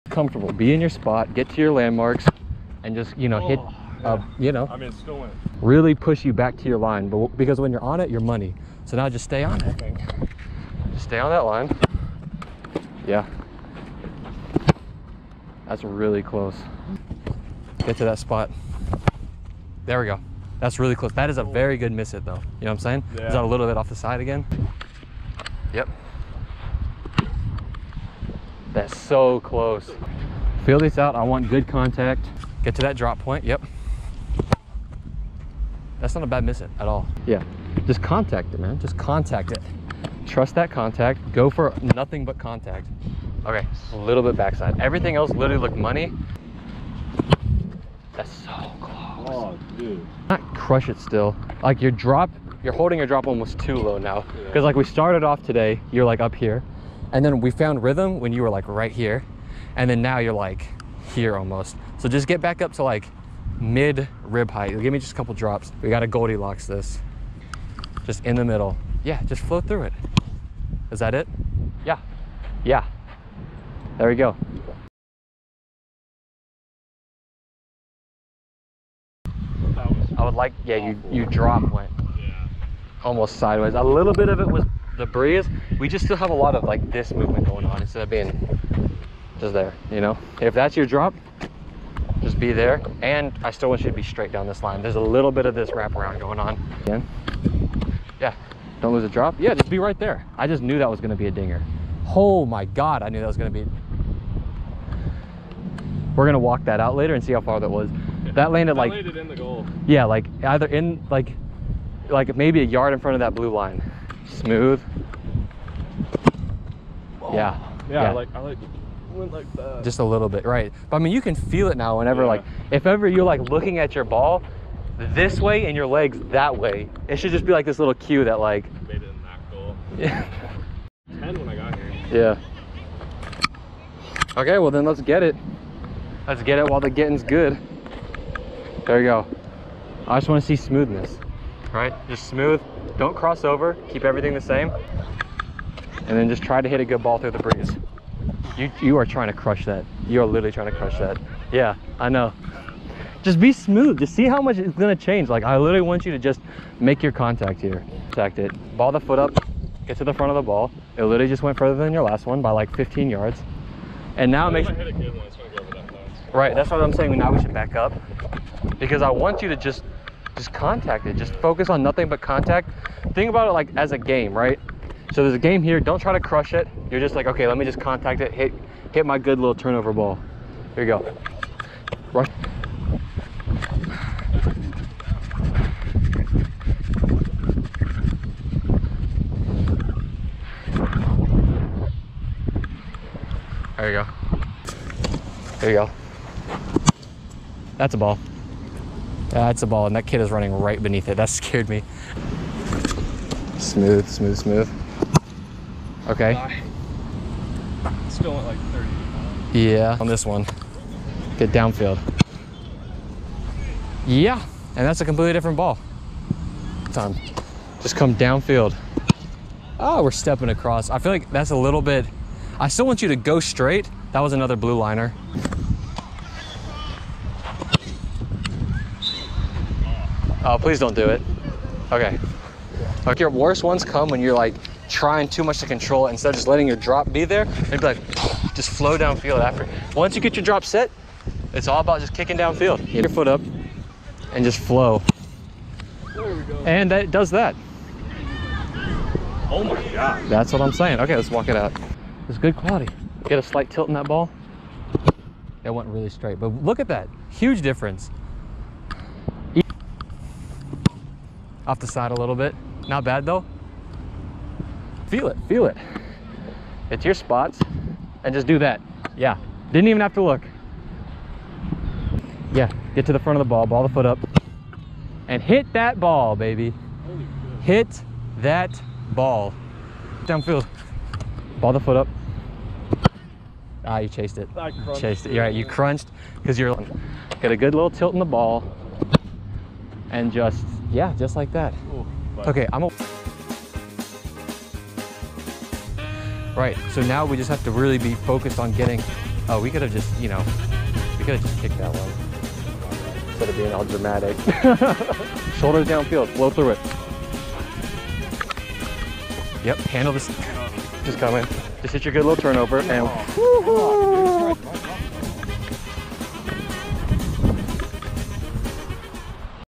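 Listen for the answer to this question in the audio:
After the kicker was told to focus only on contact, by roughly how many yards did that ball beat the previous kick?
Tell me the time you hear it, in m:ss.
2:42.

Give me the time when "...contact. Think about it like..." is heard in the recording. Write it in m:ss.
2:52.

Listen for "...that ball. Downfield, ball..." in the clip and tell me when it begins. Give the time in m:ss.
4:38.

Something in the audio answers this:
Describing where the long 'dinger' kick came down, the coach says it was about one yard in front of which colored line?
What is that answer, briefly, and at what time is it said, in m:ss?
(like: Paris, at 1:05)
Blue line, at 1:53.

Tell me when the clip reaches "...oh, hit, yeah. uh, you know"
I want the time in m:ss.
0:03.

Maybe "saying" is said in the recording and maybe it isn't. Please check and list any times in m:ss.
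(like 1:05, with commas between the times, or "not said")
0:22, 2:46, 4:10.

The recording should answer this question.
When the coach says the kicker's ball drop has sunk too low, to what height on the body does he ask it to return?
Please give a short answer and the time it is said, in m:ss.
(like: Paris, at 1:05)
Mid rib height, at 1:03.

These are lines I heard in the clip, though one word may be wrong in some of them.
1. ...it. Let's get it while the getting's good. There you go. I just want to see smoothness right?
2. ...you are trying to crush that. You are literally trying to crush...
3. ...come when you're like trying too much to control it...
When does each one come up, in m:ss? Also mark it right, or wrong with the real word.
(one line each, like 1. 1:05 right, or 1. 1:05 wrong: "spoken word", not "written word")
1. 2:15 right
2. 2:28 right
3. 3:53 right.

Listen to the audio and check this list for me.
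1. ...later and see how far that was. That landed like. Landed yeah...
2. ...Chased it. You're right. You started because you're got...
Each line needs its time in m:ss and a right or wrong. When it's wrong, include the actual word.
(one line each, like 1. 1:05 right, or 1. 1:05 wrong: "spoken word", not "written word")
1. 1:46 right
2. 4:44 wrong: "crunched", not "started".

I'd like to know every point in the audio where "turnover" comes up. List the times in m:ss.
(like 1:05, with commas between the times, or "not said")
2:59, 5:12.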